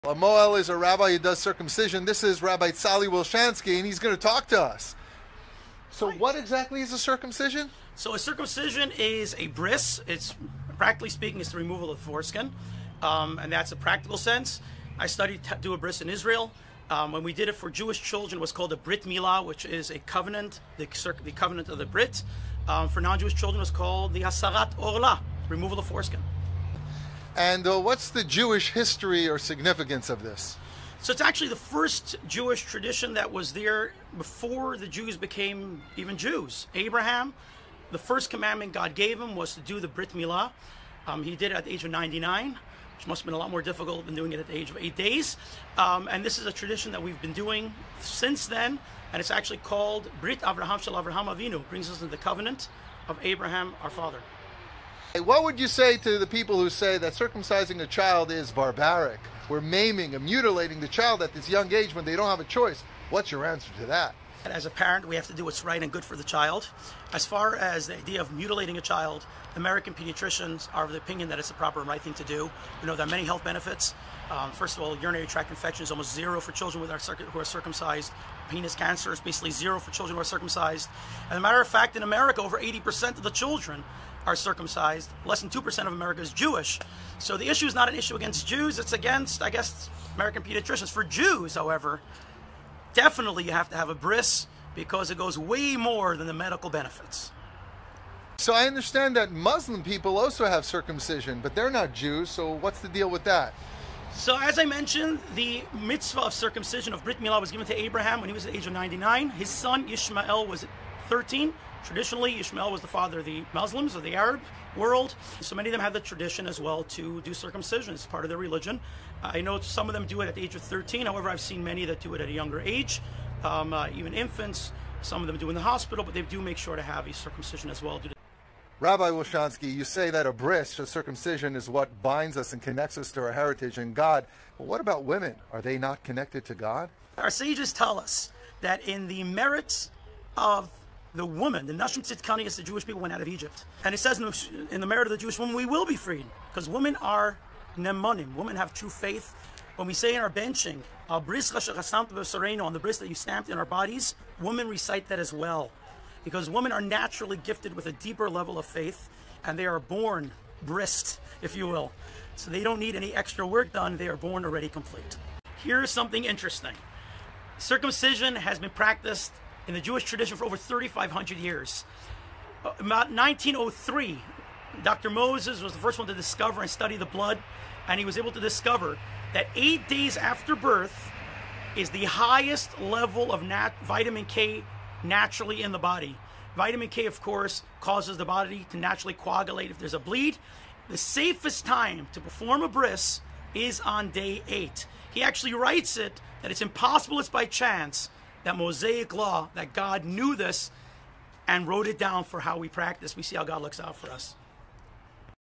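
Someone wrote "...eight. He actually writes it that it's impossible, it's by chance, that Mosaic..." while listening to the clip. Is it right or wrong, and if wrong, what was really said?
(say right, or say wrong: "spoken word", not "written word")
right.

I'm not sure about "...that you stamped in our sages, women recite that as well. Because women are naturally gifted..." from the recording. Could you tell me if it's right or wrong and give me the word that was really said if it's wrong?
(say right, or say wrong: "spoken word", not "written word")
wrong: "bodies", not "sages".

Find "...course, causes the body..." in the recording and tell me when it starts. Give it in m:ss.
3:07.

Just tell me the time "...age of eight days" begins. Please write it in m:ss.
0:44.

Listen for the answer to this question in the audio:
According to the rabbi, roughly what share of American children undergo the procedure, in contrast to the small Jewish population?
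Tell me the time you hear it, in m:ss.
1:22.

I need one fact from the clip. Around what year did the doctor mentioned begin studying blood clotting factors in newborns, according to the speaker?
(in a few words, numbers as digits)
1903.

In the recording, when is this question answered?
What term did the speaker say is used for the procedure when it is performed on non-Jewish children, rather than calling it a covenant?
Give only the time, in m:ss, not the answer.
0:24.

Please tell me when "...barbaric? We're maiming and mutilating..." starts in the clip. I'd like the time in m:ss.
0:58.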